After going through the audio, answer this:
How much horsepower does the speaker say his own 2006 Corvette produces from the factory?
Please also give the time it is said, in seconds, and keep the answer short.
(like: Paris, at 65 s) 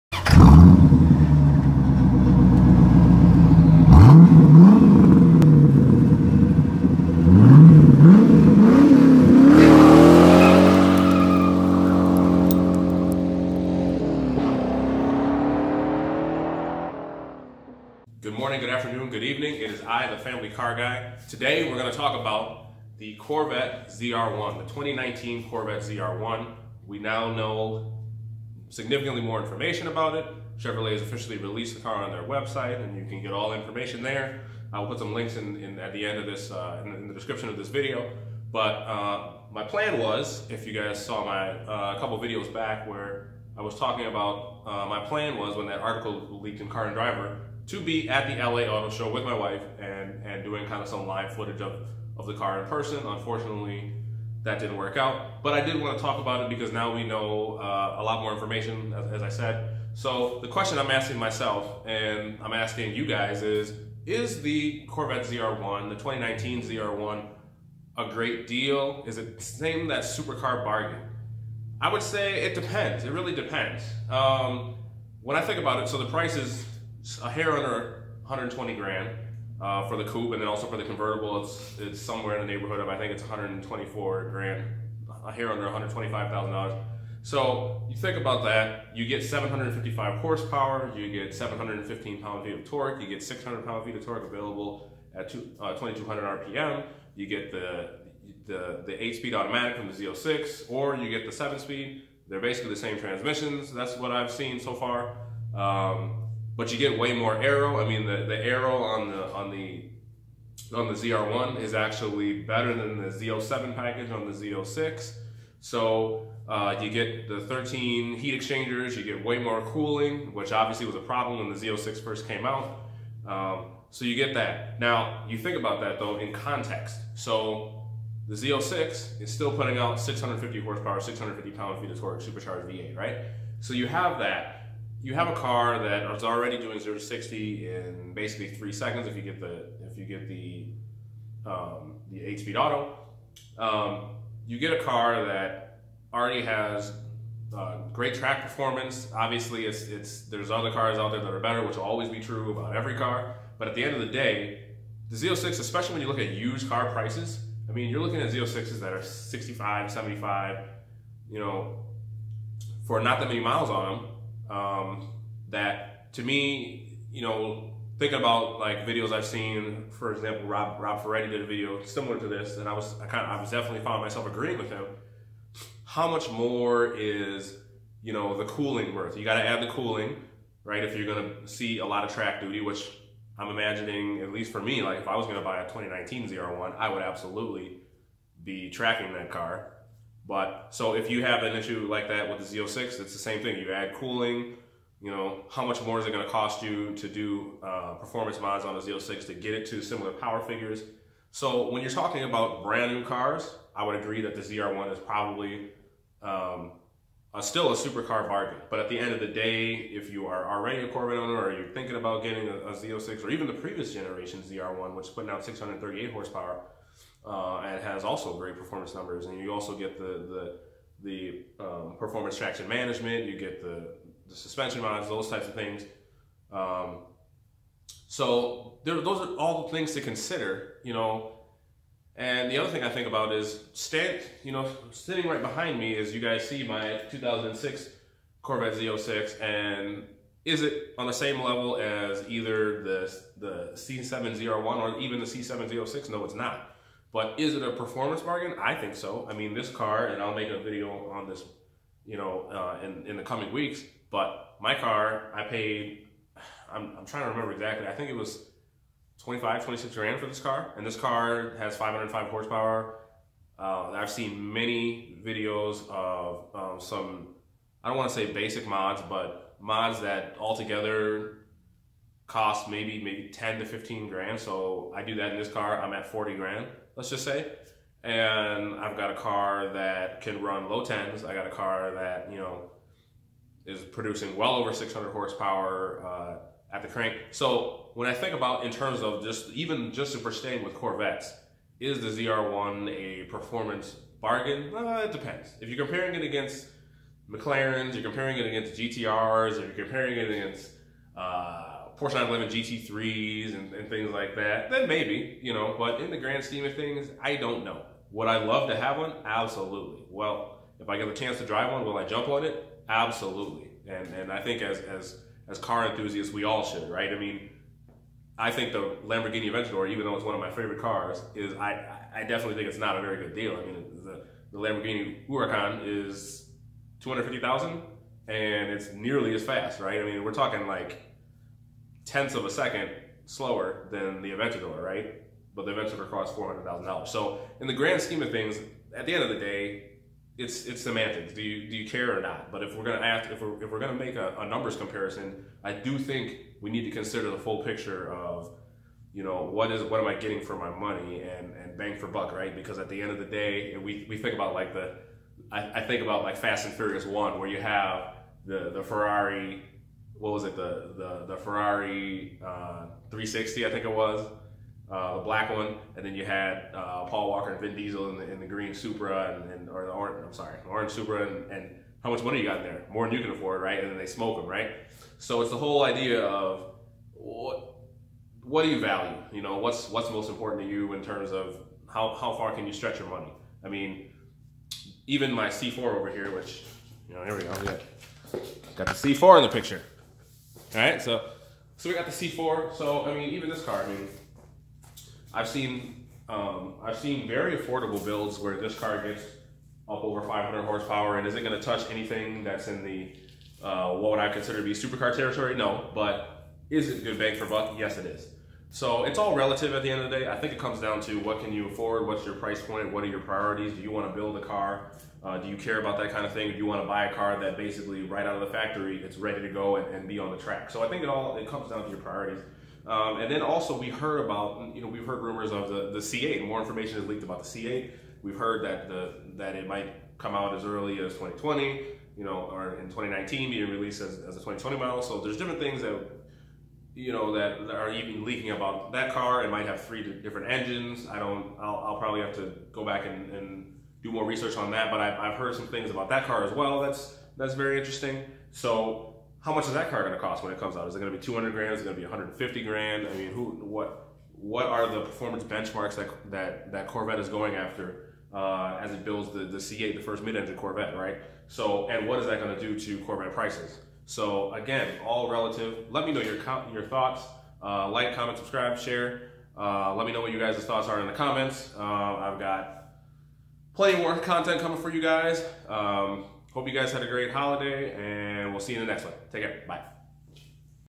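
505, at 261 s.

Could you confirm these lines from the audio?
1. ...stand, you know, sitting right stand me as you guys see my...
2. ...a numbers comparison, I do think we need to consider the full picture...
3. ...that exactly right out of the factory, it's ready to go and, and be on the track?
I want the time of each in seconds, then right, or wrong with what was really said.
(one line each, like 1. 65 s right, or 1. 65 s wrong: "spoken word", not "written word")
1. 233 s wrong: "behind", not "stand"
2. 344 s right
3. 417 s wrong: "basically", not "exactly".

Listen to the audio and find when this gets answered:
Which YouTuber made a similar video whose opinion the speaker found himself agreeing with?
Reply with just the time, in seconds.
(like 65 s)
170 s.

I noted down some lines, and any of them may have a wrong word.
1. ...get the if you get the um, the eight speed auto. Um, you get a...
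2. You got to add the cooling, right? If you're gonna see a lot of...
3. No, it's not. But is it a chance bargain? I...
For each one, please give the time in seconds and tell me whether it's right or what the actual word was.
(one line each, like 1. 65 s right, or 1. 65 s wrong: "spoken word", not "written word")
1. 139 s right
2. 179 s right
3. 246 s wrong: "performance", not "chance".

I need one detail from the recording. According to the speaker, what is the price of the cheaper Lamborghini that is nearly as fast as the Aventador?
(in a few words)
$250,000.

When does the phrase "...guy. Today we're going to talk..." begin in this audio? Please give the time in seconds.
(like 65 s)
20 s.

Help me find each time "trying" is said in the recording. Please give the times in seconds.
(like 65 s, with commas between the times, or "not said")
257 s.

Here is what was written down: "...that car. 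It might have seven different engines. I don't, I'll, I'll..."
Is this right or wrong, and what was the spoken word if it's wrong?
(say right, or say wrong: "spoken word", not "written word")
wrong: "three", not "seven".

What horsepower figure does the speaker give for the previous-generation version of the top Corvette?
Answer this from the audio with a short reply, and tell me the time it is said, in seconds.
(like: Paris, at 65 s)
638, at 215 s.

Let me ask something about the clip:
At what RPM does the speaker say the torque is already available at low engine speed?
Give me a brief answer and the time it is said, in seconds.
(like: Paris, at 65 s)
2200 RPM, at 95 s.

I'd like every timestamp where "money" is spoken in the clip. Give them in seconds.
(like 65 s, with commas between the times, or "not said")
350 s, 372 s, 383 s.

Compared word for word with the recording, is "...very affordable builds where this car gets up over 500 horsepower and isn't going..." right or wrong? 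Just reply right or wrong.
right.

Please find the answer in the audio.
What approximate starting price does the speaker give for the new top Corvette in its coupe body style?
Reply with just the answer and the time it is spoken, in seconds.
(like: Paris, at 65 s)
a hair under $120,000, at 77 s.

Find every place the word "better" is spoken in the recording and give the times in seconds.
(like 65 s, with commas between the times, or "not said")
112 s, 151 s.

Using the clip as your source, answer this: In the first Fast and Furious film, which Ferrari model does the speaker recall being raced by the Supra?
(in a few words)
Ferrari 360.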